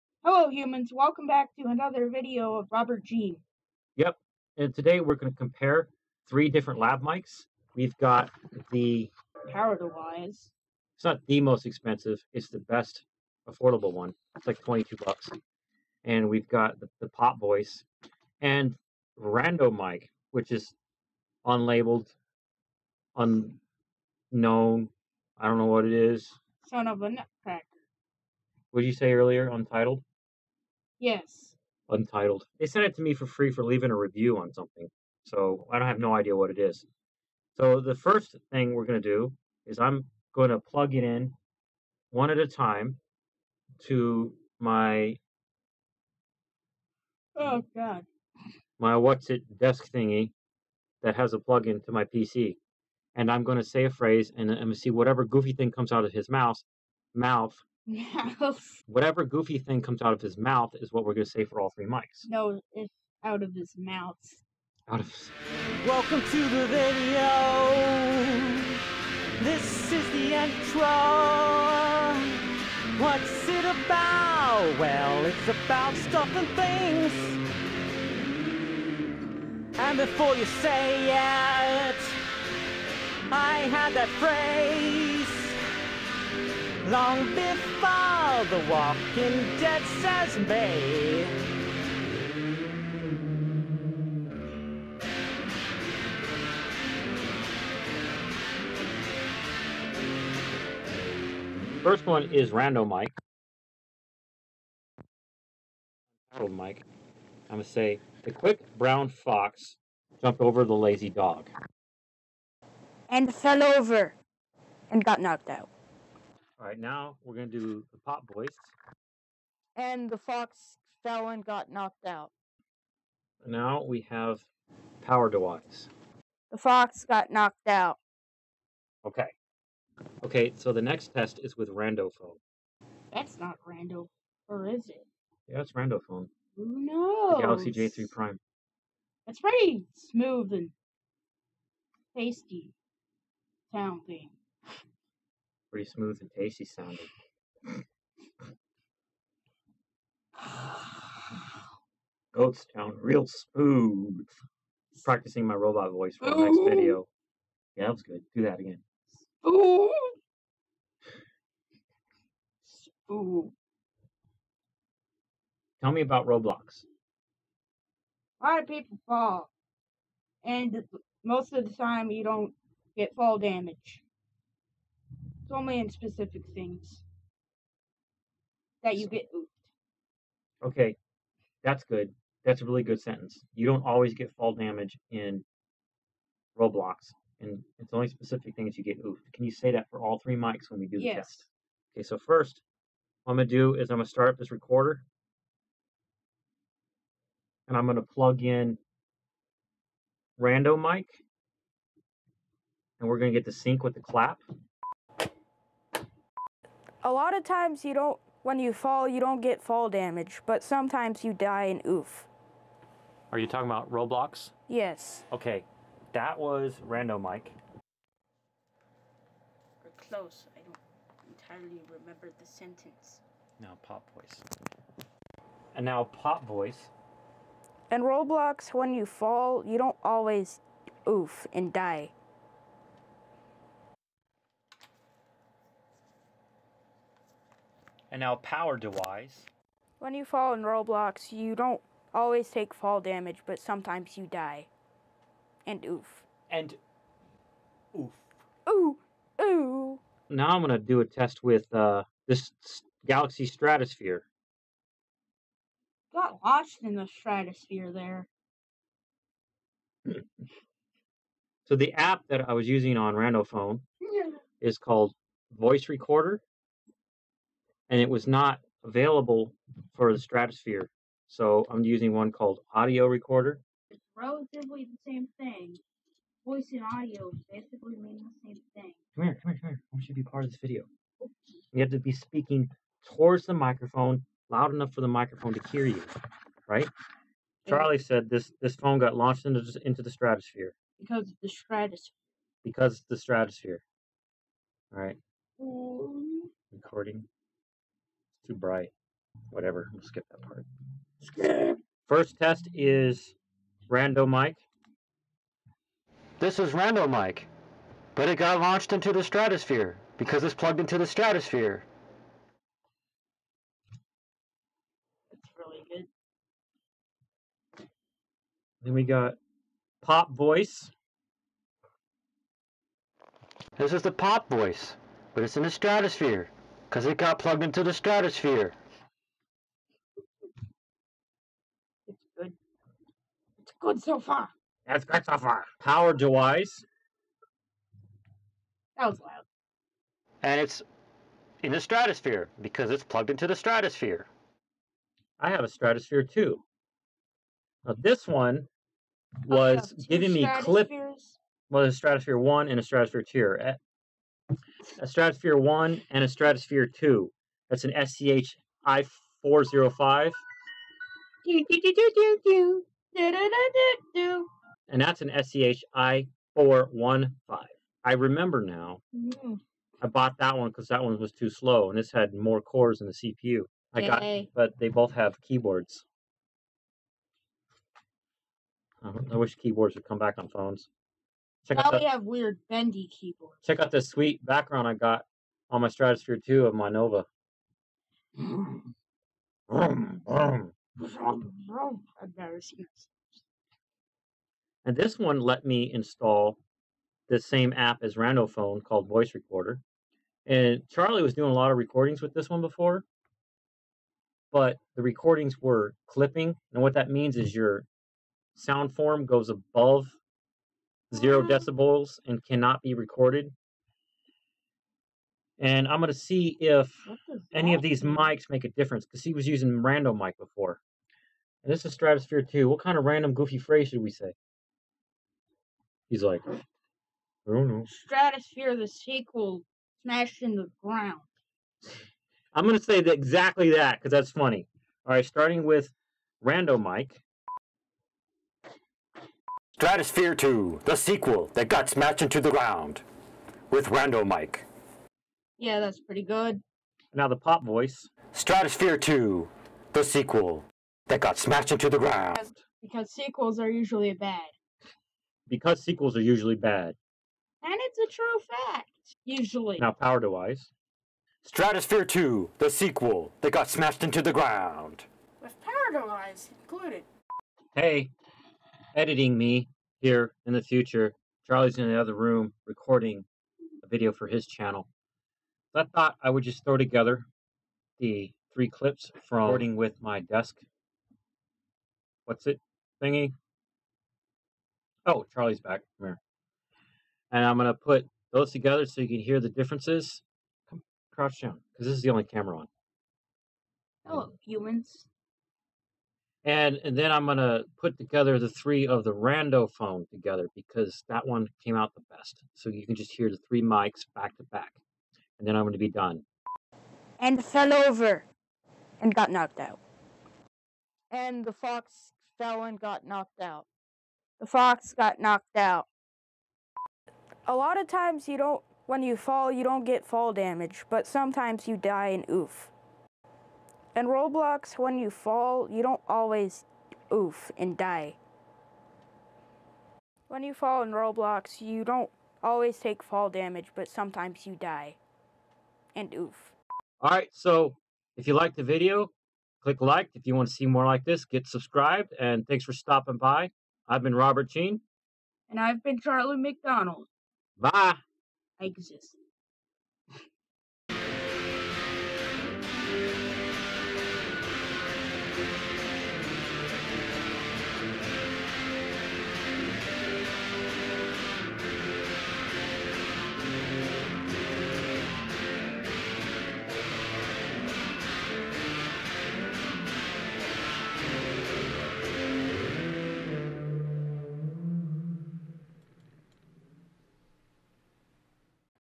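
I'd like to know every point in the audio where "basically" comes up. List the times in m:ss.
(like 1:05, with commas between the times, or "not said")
4:37.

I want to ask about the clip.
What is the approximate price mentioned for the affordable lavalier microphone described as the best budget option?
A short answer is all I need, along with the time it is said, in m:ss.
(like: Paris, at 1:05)
22 bucks, at 0:14.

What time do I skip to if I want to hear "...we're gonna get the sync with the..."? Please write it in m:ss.
3:23.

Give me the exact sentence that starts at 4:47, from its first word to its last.
Charlie said this this phone got launched into into the stratosphere.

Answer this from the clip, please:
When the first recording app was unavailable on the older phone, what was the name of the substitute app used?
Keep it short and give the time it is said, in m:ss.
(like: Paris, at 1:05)
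Audio Recorder, at 4:32.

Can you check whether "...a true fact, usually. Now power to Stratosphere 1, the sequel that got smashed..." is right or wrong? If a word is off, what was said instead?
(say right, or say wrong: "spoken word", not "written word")
wrong: "2", not "1".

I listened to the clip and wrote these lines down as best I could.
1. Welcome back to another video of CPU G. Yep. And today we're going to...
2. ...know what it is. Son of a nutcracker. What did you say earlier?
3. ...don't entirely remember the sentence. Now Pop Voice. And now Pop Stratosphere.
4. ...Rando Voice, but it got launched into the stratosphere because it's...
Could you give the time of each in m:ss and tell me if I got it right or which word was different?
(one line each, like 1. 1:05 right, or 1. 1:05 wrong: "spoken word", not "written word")
1. 0:00 wrong: "Robert", not "CPU"
2. 0:25 right
3. 3:40 wrong: "Voice", not "Stratosphere"
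4. 5:06 wrong: "Mike", not "Voice".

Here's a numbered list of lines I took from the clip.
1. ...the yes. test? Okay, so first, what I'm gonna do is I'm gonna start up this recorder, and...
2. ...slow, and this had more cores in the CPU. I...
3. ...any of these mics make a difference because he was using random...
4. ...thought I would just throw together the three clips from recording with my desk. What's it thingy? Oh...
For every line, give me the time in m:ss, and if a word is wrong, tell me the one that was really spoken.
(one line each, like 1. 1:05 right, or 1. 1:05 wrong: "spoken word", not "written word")
1. 3:10 right
2. 6:11 right
3. 6:57 right
4. 7:55 right.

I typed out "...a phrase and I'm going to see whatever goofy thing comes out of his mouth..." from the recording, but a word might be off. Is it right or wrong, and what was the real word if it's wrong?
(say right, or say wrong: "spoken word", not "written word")
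right.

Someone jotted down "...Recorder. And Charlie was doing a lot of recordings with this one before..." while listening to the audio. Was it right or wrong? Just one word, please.
right.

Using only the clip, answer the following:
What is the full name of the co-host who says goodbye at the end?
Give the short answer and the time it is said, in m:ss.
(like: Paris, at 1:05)
Charlie McDonald, at 9:05.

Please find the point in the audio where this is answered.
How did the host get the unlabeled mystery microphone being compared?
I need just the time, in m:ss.
0:33.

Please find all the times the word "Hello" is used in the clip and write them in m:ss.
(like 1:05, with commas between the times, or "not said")
0:00, 8:14.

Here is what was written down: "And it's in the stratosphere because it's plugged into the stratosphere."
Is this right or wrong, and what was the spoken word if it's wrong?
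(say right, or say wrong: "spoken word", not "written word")
right.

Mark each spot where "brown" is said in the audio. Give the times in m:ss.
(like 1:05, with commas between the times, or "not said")
1:48.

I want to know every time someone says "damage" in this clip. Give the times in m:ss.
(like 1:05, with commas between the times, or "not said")
2:53, 3:04, 3:29, 4:02, 8:40, 8:53.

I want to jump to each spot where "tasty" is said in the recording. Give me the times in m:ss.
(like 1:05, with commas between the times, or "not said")
2:22, 2:26.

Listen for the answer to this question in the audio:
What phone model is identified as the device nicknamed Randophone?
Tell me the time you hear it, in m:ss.
2:17.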